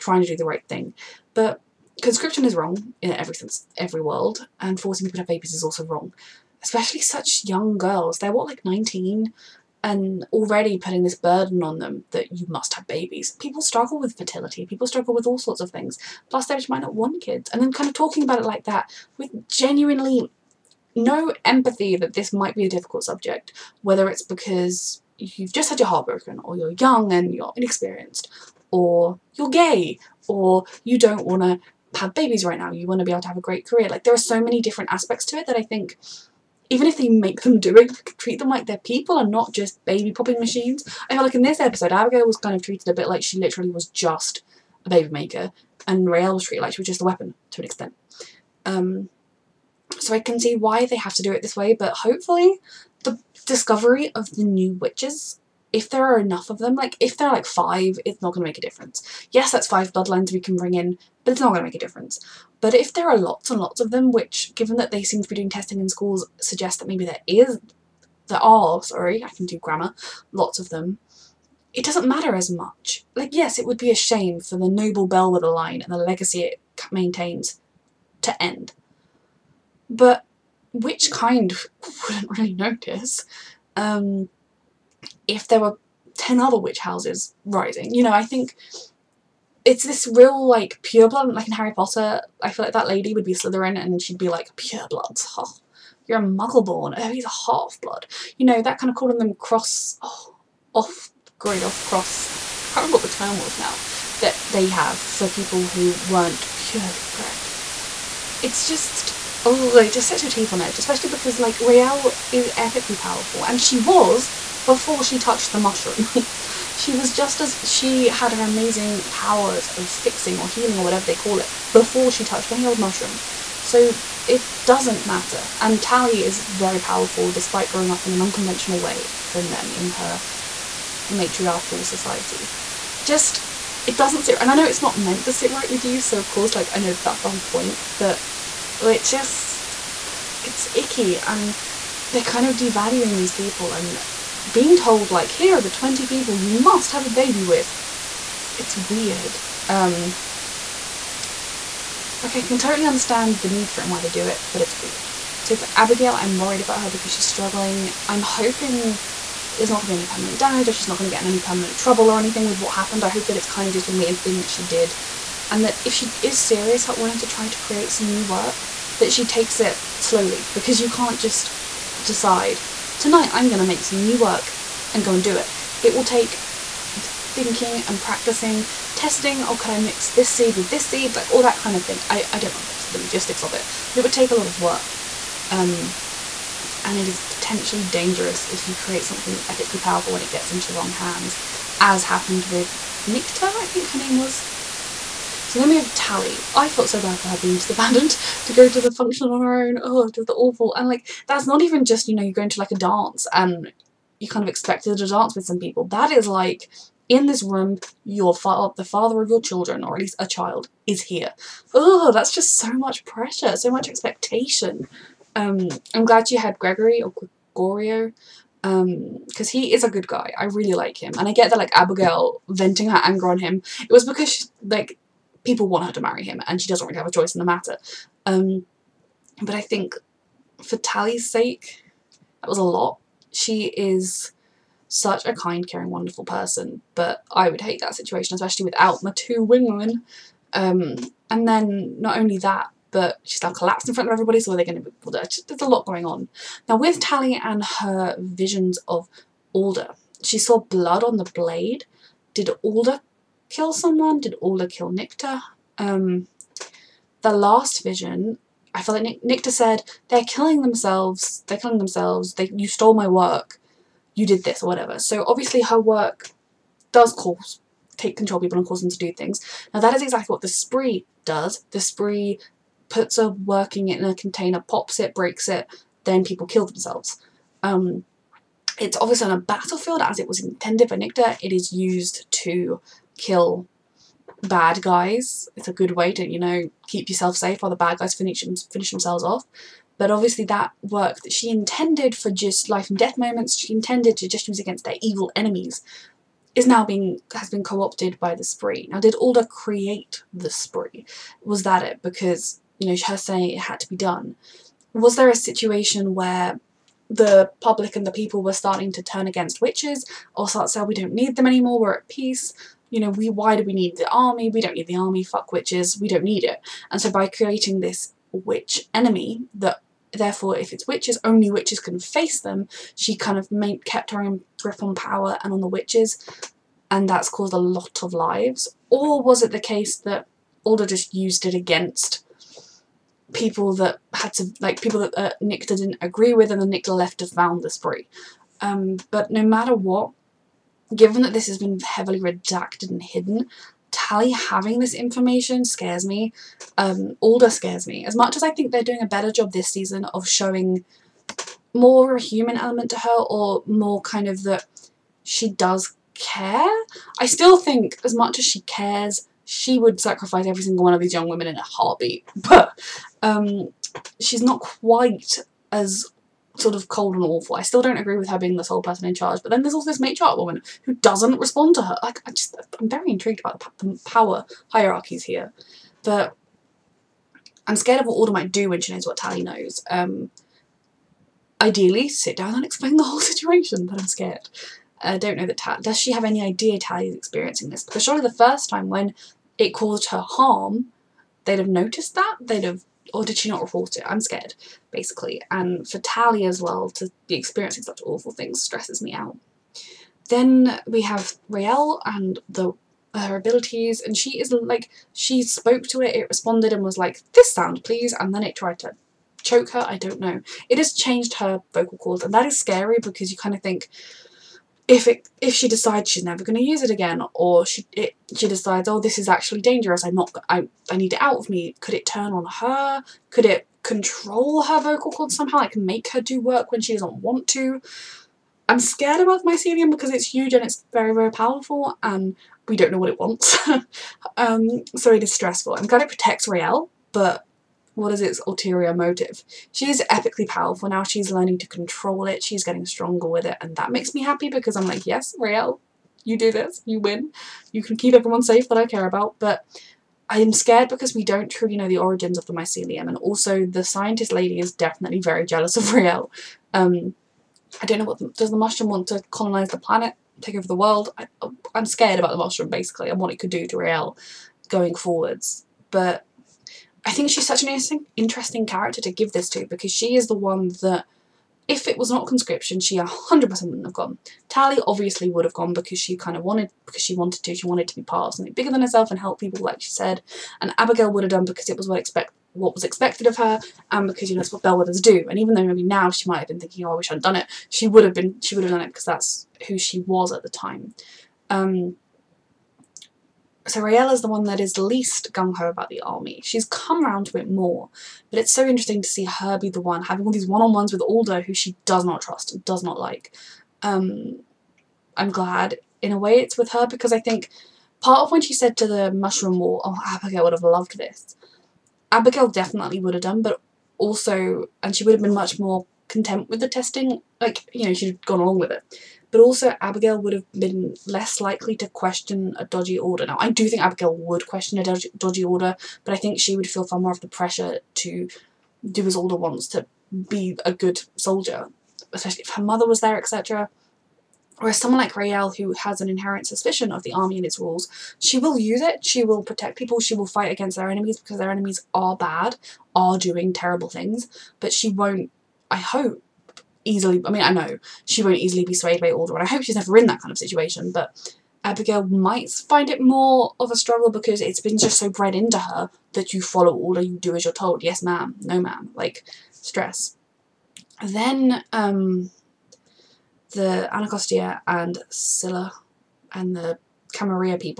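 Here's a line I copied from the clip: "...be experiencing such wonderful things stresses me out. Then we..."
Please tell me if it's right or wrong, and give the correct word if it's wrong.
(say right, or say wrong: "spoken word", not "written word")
wrong: "awful", not "wonderful".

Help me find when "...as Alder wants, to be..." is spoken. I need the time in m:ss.
8:49.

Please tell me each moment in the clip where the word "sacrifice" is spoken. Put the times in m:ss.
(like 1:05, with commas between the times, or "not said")
5:59.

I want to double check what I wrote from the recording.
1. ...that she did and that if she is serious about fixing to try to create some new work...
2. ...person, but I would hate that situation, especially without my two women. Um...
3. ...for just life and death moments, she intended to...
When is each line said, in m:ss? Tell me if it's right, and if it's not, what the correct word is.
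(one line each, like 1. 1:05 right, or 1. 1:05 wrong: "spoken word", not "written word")
1. 2:44 wrong: "wanting", not "fixing"
2. 3:56 right
3. 4:52 right.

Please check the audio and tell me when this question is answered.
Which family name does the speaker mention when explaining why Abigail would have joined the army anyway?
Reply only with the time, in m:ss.
8:04.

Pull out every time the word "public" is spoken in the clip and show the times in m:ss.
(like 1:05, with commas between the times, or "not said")
5:07.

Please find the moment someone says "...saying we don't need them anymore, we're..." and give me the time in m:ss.
5:10.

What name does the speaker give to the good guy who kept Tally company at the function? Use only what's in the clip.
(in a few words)
Gregorio.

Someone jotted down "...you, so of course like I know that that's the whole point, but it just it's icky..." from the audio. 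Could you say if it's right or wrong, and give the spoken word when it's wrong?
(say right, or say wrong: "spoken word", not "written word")
right.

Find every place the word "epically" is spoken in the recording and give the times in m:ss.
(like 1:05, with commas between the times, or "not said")
1:52, 3:09, 7:20.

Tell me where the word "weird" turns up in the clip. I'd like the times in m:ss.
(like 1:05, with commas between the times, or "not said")
2:28, 2:34.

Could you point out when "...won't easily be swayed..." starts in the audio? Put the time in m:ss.
9:08.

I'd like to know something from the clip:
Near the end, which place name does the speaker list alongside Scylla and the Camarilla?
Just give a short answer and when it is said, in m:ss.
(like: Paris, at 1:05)
Anacostia, at 9:23.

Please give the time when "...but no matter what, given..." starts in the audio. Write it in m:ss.
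5:39.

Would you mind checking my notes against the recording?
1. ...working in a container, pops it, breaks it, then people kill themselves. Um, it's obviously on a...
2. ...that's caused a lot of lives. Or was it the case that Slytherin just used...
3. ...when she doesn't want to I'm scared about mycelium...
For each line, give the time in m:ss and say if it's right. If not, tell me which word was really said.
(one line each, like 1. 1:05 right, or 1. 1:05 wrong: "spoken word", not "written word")
1. 4:33 right
2. 5:27 wrong: "Alder", not "Slytherin"
3. 7:06 right.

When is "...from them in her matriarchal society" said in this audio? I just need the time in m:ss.
2:09.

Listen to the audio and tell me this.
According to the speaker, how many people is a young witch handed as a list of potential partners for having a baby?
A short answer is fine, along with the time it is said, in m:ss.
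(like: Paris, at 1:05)
20, at 2:25.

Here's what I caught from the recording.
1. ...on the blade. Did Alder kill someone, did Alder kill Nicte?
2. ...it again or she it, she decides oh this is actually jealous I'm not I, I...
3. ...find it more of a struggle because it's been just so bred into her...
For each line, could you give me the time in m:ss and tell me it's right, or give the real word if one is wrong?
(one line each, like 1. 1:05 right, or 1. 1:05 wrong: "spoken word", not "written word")
1. 4:11 right
2. 6:56 wrong: "dangerous", not "jealous"
3. 9:12 right.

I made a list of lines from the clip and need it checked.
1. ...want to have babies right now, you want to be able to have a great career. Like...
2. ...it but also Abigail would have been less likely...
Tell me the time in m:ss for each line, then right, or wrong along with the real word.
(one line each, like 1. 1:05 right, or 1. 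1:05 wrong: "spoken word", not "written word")
1. 0:31 right
2. 8:38 right.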